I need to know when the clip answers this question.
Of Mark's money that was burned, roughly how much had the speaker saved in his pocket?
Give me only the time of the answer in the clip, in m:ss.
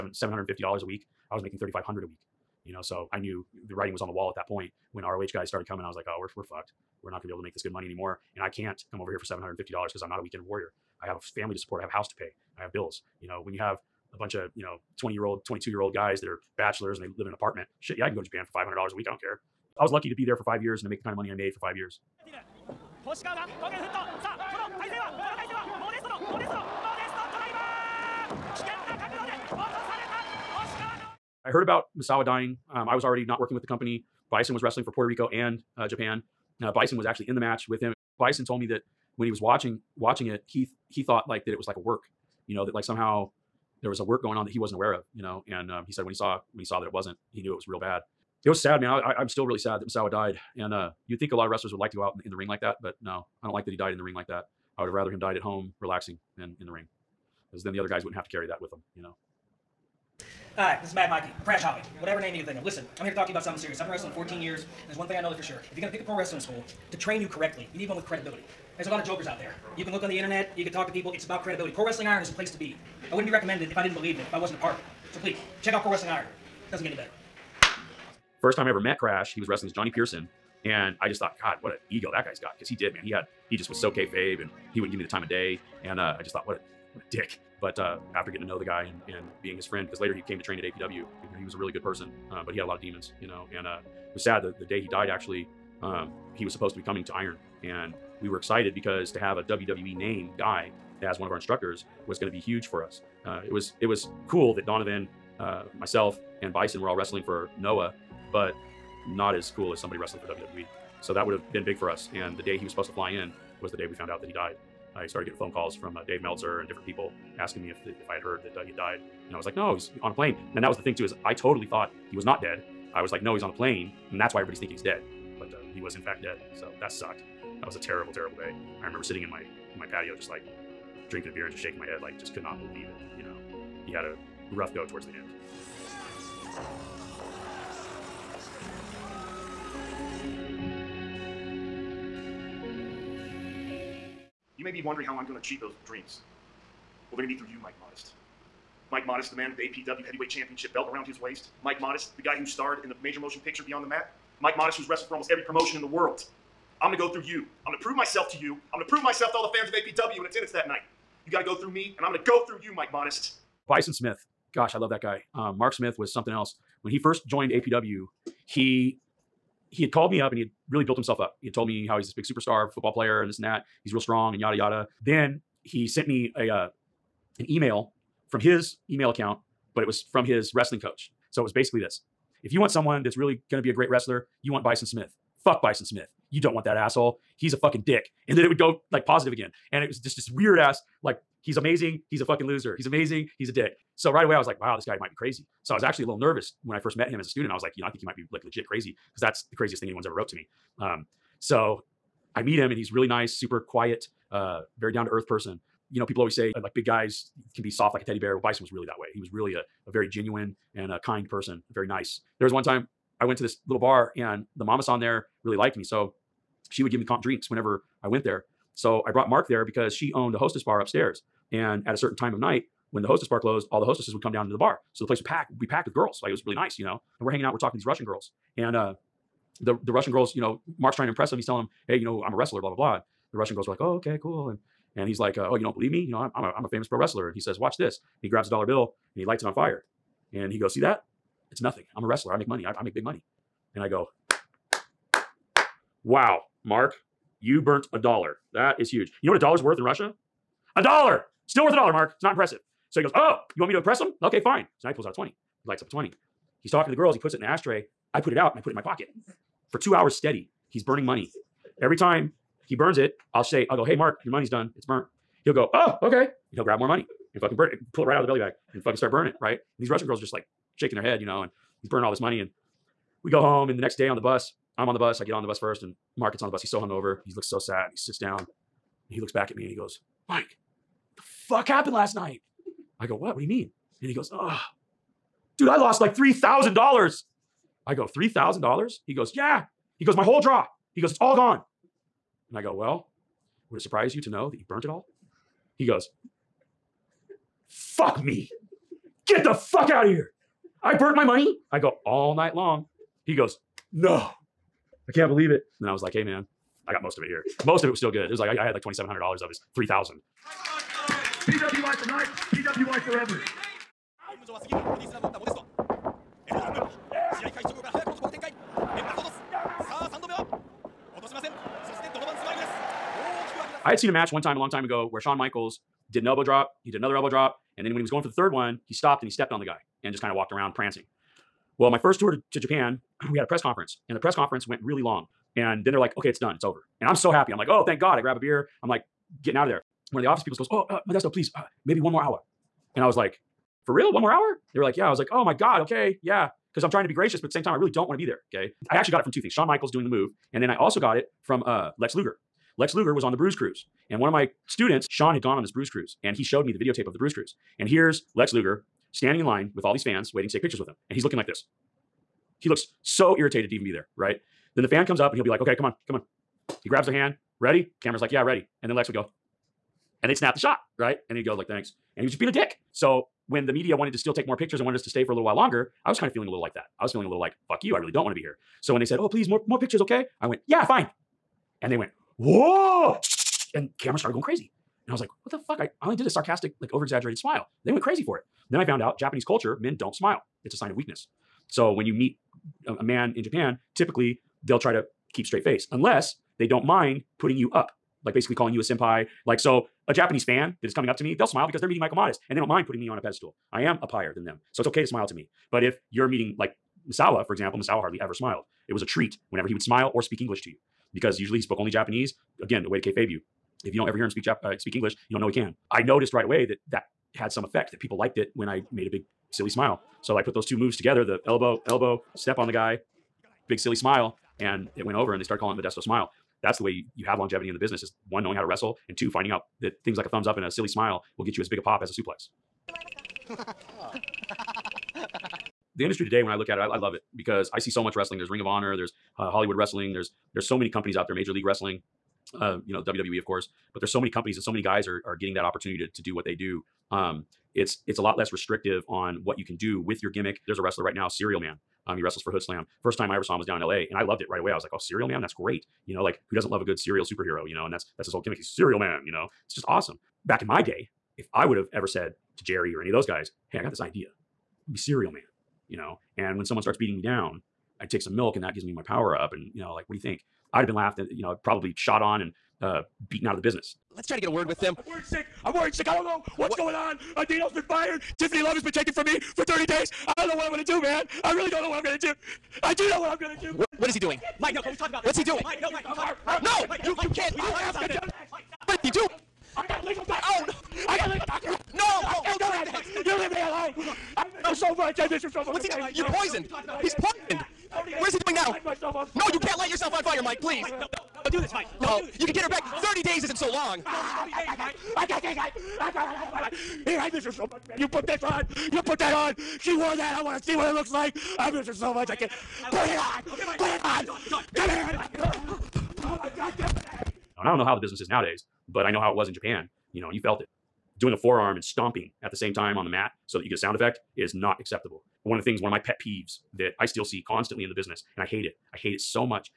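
5:08.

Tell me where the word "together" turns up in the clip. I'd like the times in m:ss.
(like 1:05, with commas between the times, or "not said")
7:00.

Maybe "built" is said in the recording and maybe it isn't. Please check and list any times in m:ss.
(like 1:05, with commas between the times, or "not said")
2:50.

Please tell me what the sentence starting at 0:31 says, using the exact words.
I heard about Misawa dying, um, I was already not working with the company.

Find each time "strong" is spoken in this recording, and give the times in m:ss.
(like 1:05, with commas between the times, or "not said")
2:53.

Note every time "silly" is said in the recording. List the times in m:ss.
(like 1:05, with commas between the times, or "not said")
6:59, 7:03, 7:10.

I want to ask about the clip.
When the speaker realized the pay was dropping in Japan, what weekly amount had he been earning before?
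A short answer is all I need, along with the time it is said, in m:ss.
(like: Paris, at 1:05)
$3,500, at 0:01.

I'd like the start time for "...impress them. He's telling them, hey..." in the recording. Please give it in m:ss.
3:51.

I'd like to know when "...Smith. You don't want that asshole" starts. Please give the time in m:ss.
3:05.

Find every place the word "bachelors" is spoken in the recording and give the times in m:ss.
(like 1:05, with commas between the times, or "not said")
0:16.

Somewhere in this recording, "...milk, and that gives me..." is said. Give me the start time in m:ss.
7:48.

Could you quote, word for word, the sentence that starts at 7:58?
Tiffany Love has been taken from me for 30 days.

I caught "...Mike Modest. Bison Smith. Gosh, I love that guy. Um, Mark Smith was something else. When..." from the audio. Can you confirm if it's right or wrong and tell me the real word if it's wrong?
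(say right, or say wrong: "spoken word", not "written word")
right.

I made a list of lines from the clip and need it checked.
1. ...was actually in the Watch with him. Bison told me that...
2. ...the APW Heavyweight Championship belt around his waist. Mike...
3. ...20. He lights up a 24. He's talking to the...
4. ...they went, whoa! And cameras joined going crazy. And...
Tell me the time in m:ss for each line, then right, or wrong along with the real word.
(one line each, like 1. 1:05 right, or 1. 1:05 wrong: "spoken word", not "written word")
1. 0:36 wrong: "match", not "Watch"
2. 2:29 right
3. 4:15 wrong: "20", not "24"
4. 6:21 wrong: "started", not "joined".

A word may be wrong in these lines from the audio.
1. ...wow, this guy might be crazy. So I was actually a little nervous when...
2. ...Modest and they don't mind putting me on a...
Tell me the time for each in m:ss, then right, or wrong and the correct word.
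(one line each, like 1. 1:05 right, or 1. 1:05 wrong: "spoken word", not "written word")
1. 3:14 right
2. 6:42 right.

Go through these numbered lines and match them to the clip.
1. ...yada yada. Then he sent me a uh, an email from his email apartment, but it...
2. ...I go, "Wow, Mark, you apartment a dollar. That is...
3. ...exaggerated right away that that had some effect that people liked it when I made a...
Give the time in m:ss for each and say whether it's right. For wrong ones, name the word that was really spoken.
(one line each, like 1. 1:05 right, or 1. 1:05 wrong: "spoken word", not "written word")
1. 2:54 wrong: "account", not "apartment"
2. 4:03 wrong: "burnt", not "apartment"
3. 6:56 wrong: "noticed", not "exaggerated".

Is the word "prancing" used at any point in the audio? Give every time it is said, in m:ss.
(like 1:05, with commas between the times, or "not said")
5:30.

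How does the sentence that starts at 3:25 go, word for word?
You know, people always say uh, like big guys can be soft like a teddy bear.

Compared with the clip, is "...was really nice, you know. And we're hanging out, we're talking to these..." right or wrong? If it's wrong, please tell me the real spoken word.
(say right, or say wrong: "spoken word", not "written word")
right.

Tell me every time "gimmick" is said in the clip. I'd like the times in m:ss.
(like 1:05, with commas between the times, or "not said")
7:30, 7:38.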